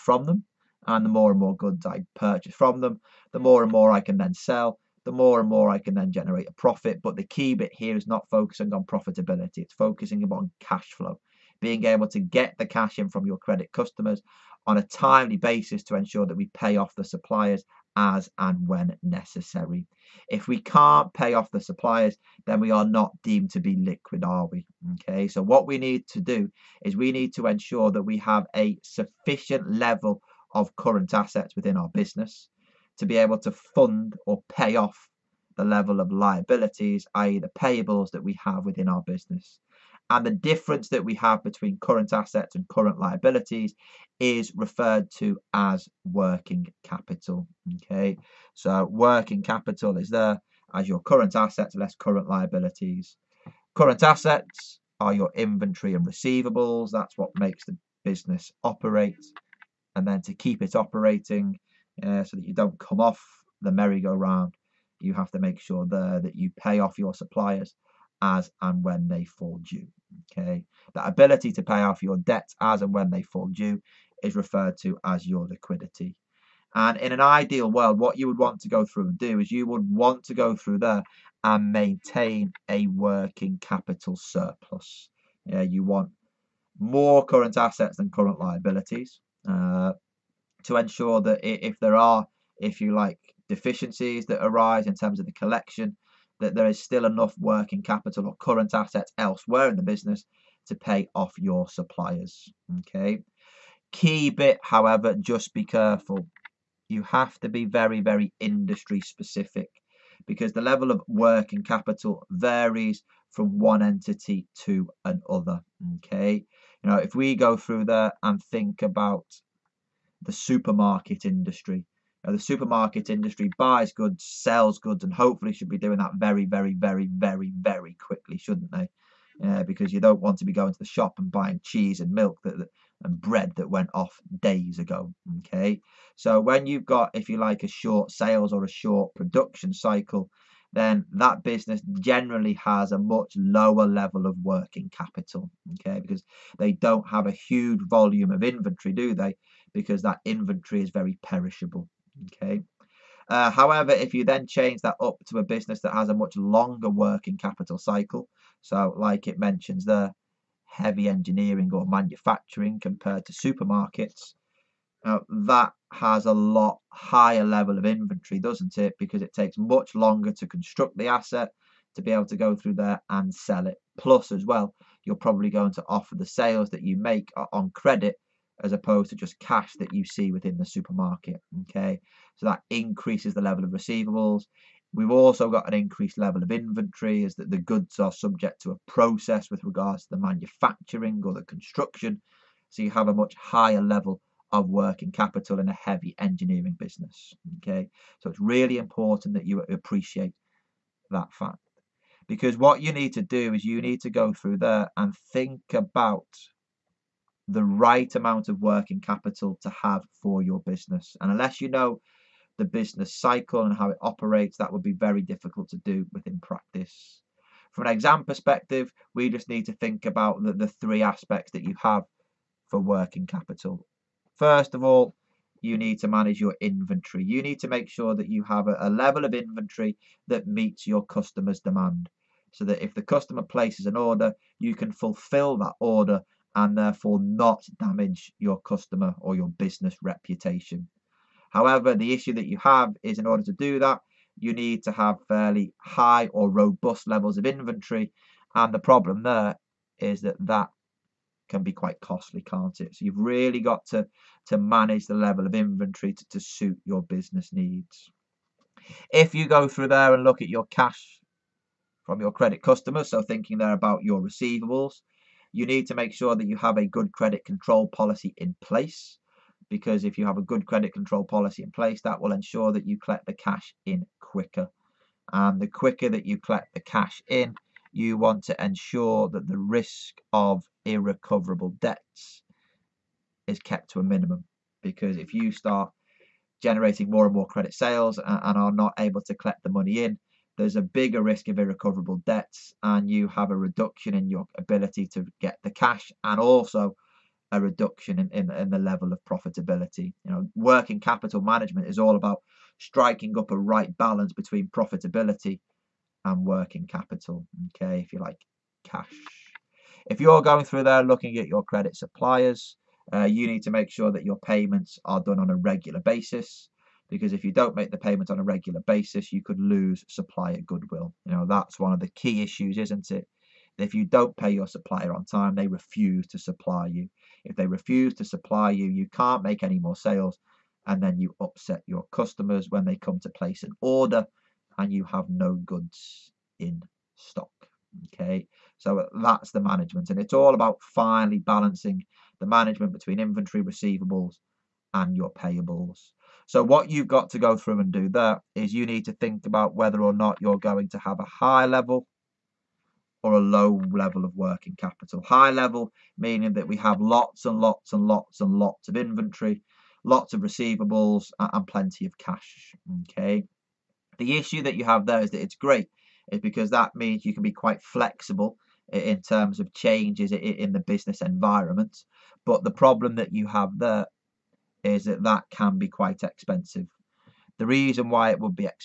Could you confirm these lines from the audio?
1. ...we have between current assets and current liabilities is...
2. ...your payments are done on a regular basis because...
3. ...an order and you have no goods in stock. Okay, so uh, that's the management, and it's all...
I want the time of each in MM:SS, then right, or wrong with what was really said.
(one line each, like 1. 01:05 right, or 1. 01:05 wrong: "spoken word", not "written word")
1. 00:41 right
2. 05:14 right
3. 05:33 right.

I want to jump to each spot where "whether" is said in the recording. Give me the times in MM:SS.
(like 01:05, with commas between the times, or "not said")
05:49.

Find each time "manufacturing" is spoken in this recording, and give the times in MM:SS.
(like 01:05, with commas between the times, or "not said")
02:41, 03:10.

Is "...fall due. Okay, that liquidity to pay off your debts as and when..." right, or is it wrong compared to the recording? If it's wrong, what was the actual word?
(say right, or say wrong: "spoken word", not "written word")
wrong: "ability", not "liquidity".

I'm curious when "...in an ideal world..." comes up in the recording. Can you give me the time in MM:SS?
01:16.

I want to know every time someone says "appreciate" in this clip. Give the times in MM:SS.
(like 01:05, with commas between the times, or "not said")
03:19.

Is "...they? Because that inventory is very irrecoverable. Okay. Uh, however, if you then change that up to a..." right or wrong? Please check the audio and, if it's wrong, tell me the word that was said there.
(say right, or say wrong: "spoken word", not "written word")
wrong: "perishable", not "irrecoverable".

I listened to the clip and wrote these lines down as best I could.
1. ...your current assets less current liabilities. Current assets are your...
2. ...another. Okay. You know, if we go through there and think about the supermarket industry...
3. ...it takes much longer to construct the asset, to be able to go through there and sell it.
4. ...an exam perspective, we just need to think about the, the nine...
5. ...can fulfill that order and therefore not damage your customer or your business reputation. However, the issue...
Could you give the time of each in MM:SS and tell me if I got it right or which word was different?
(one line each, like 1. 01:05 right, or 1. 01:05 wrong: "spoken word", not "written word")
1. 00:50 right
2. 01:55 right
3. 02:49 right
4. 03:37 wrong: "three", not "nine"
5. 03:54 right.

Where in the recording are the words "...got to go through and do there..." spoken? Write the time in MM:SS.
05:47.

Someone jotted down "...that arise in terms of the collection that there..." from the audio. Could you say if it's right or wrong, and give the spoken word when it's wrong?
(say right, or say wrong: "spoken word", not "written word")
right.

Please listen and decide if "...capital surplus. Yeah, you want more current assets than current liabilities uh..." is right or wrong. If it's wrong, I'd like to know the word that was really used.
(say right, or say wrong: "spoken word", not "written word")
right.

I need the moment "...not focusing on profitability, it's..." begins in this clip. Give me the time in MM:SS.
00:08.